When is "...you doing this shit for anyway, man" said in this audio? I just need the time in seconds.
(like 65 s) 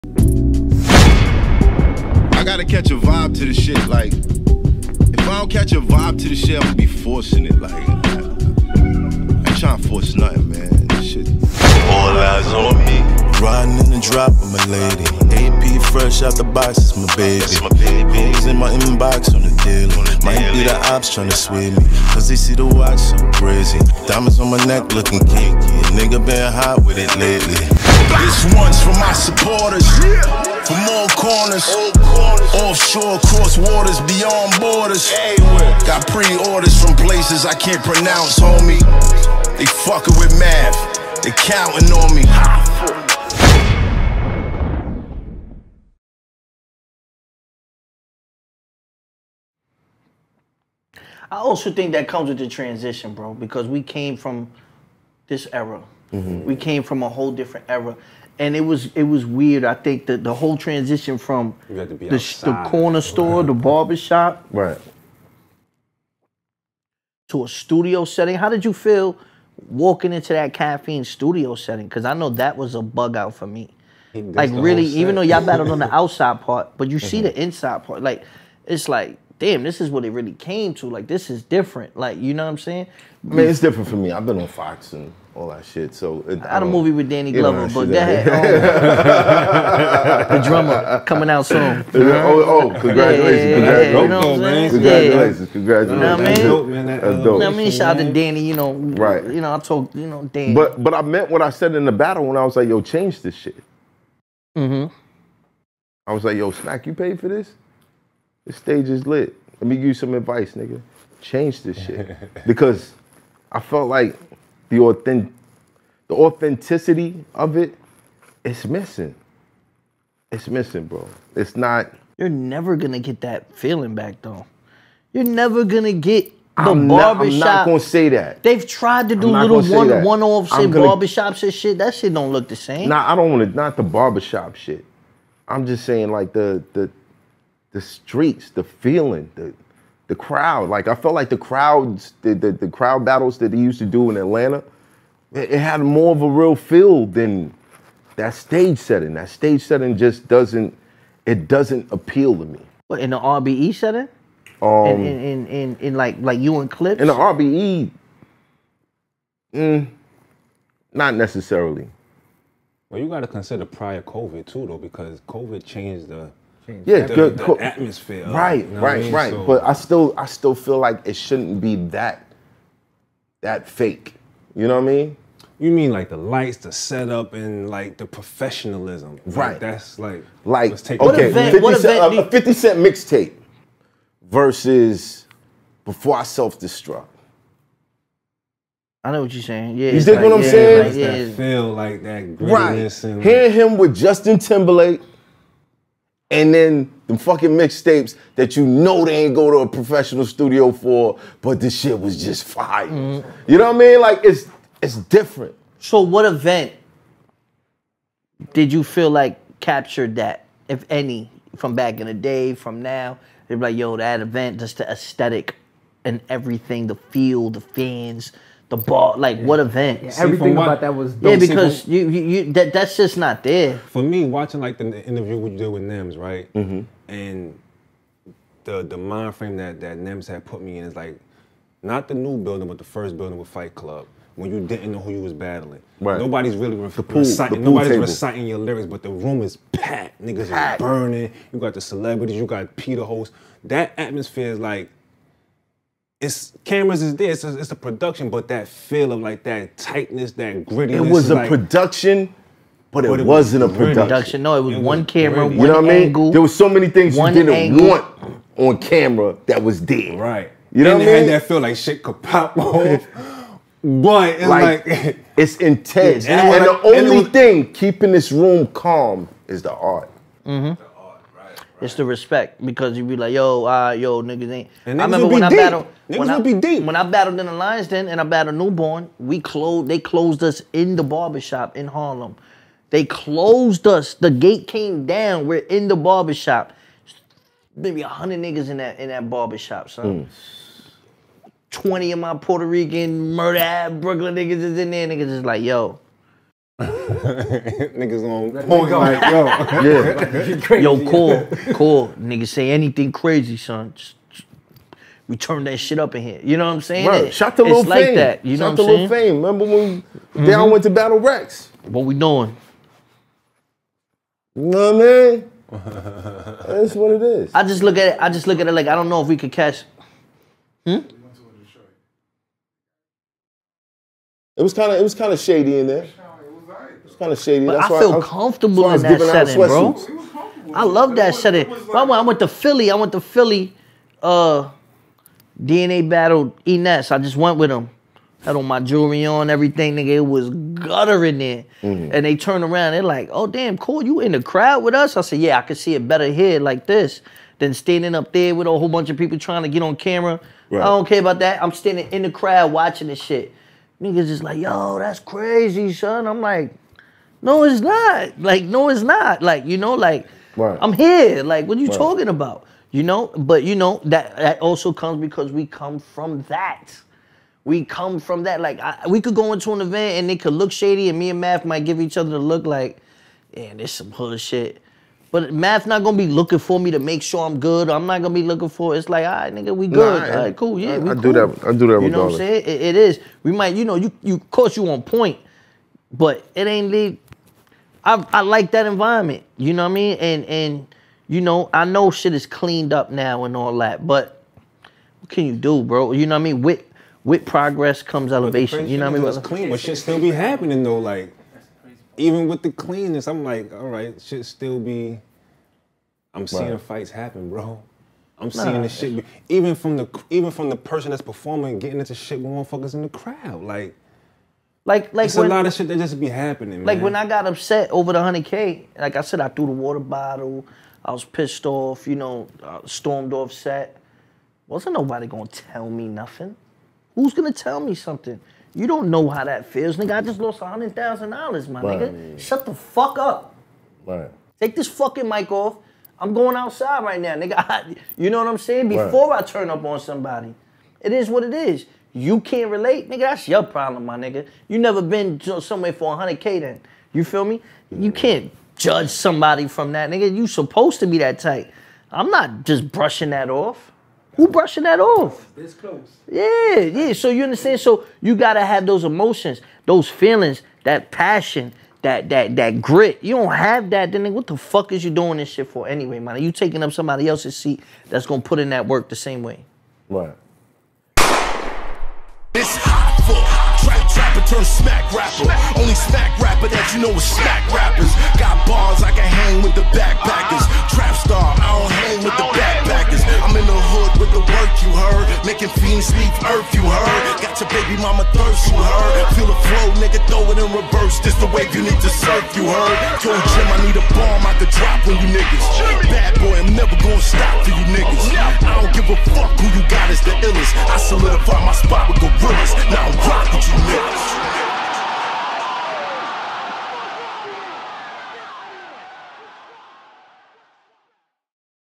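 465 s.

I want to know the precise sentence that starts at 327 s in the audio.
But that's I feel I, comfortable in that setting, bro.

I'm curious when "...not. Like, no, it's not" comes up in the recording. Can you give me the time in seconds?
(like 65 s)
357 s.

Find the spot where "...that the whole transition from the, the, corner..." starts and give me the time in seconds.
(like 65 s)
60 s.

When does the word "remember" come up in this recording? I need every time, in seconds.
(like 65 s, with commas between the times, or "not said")
275 s, 309 s.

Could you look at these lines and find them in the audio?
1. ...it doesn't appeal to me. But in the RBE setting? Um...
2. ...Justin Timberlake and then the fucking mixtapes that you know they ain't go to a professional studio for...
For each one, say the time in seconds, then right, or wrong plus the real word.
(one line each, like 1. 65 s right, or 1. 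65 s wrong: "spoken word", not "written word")
1. 151 s right
2. 193 s right.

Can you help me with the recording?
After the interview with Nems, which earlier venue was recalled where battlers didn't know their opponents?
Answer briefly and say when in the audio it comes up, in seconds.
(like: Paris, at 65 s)
Fight Club, at 233 s.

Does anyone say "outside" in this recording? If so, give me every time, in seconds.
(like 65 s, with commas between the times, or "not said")
75 s, 436 s.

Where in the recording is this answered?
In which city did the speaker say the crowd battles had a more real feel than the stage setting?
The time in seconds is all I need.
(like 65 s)
144 s.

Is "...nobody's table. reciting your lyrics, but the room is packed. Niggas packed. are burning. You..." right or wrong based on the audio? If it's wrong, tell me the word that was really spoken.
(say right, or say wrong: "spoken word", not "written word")
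right.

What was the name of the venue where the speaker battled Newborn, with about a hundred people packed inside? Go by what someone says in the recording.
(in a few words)
Lions Den.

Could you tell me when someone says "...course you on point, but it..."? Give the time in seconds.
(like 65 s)
384 s.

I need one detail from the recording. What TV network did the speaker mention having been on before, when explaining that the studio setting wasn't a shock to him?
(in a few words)
Fox.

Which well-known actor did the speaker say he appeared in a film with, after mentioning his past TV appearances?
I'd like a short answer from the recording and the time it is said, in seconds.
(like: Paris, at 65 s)
Danny Glover, at 87 s.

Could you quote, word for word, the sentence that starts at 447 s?
You can't judge somebody from that, nigga.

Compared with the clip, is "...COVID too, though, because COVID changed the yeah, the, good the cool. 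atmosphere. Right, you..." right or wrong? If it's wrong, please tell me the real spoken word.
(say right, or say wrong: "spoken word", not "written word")
right.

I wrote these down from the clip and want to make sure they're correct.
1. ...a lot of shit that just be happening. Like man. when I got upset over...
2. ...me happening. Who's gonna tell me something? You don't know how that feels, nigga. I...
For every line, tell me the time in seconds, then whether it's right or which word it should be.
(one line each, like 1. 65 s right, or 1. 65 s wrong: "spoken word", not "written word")
1. 415 s right
2. 425 s wrong: "nothing", not "happening".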